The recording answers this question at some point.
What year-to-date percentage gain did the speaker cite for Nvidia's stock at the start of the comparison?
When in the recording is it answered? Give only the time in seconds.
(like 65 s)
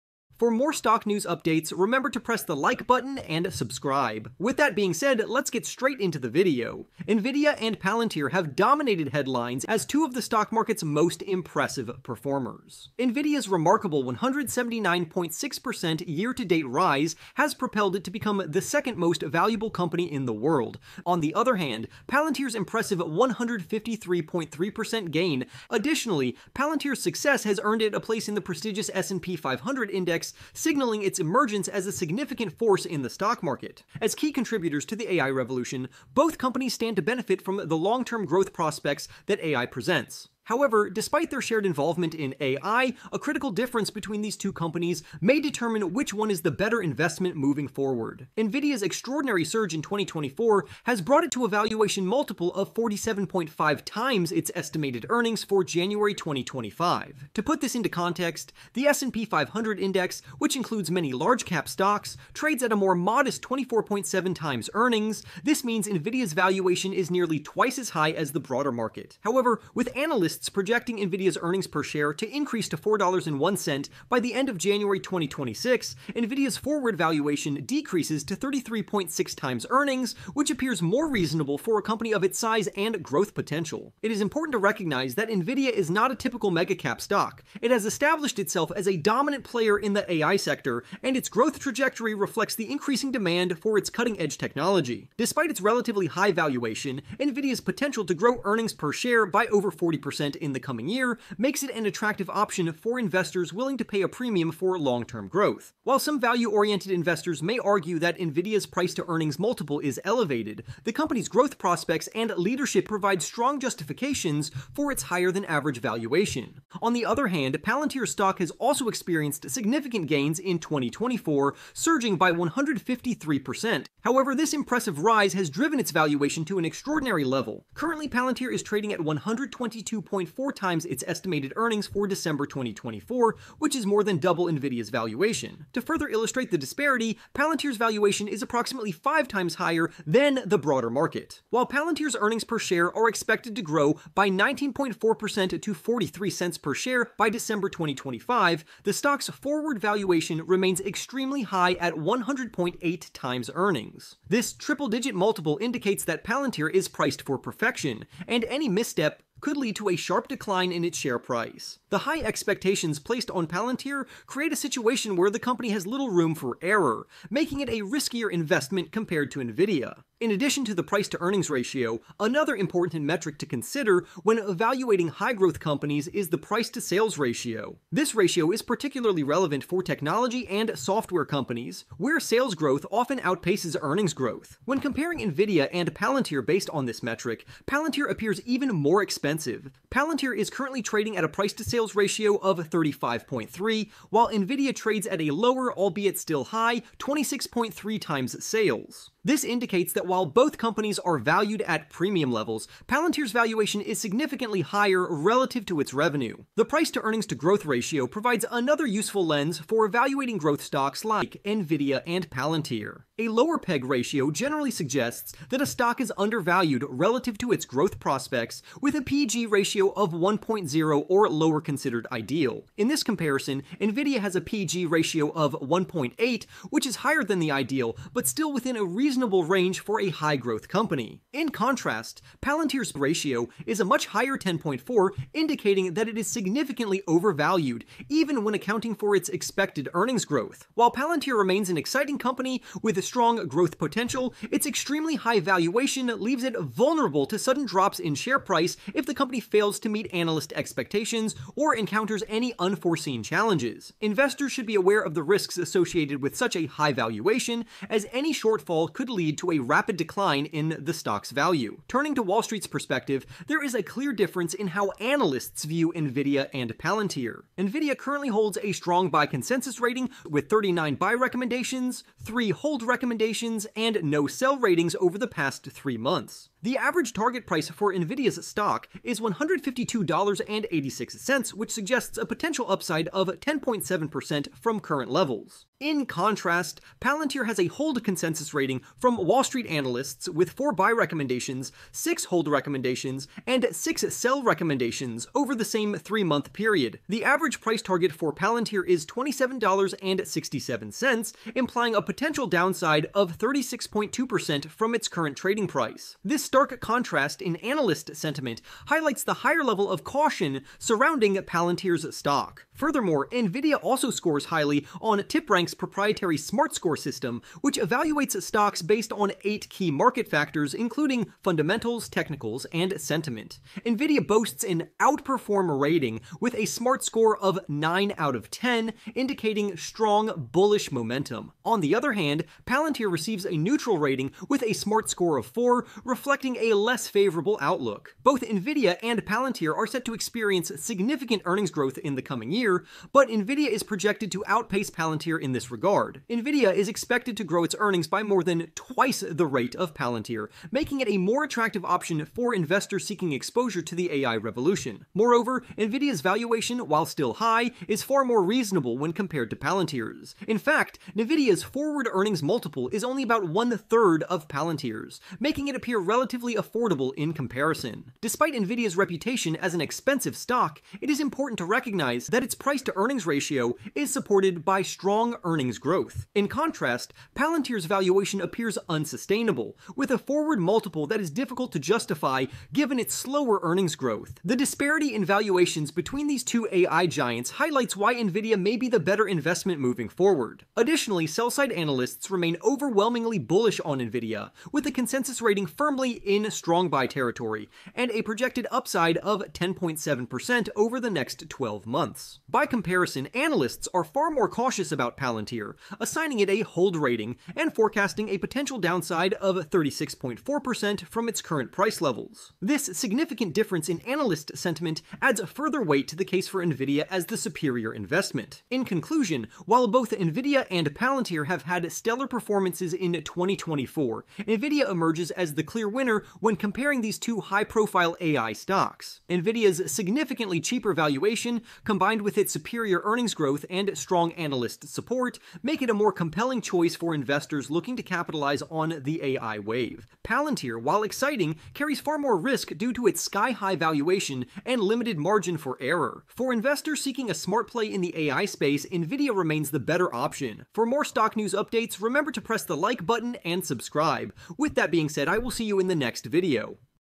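14 s.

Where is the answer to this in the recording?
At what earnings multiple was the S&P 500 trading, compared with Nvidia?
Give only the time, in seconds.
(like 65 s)
63 s.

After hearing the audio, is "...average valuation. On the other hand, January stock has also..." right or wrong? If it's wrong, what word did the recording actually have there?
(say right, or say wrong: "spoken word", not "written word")
wrong: "Palantir", not "January".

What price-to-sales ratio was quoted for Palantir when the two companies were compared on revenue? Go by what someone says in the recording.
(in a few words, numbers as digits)
35.3.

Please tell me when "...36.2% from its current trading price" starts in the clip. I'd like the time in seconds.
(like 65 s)
303 s.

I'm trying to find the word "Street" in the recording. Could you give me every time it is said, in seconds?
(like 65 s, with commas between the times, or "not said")
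262 s, 289 s.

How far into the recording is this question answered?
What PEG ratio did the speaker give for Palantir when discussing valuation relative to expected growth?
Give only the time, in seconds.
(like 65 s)
234 s.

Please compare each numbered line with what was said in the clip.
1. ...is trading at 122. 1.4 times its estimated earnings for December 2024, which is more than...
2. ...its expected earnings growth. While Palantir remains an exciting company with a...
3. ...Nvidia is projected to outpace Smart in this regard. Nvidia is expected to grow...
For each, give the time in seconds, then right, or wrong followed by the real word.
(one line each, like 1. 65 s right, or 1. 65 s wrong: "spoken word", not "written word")
1. 128 s right
2. 239 s right
3. 343 s wrong: "Palantir", not "Smart".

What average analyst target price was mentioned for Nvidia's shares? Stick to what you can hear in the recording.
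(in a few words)
$152.86.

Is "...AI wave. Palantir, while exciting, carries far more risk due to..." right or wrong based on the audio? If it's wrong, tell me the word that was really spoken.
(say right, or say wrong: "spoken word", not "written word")
right.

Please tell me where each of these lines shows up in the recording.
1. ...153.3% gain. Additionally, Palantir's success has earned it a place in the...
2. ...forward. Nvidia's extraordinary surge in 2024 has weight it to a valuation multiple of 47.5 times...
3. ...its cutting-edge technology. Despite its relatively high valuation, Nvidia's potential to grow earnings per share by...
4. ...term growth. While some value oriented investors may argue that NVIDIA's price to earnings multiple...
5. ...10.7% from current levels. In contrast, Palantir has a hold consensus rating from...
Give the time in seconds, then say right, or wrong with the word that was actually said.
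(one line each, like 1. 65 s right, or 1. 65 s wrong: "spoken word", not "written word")
1. 22 s right
2. 47 s wrong: "brought", not "weight"
3. 93 s right
4. 105 s right
5. 283 s right.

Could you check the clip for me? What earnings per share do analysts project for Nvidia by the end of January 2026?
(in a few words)
$4.01.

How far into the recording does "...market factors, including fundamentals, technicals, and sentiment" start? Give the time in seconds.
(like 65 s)
319 s.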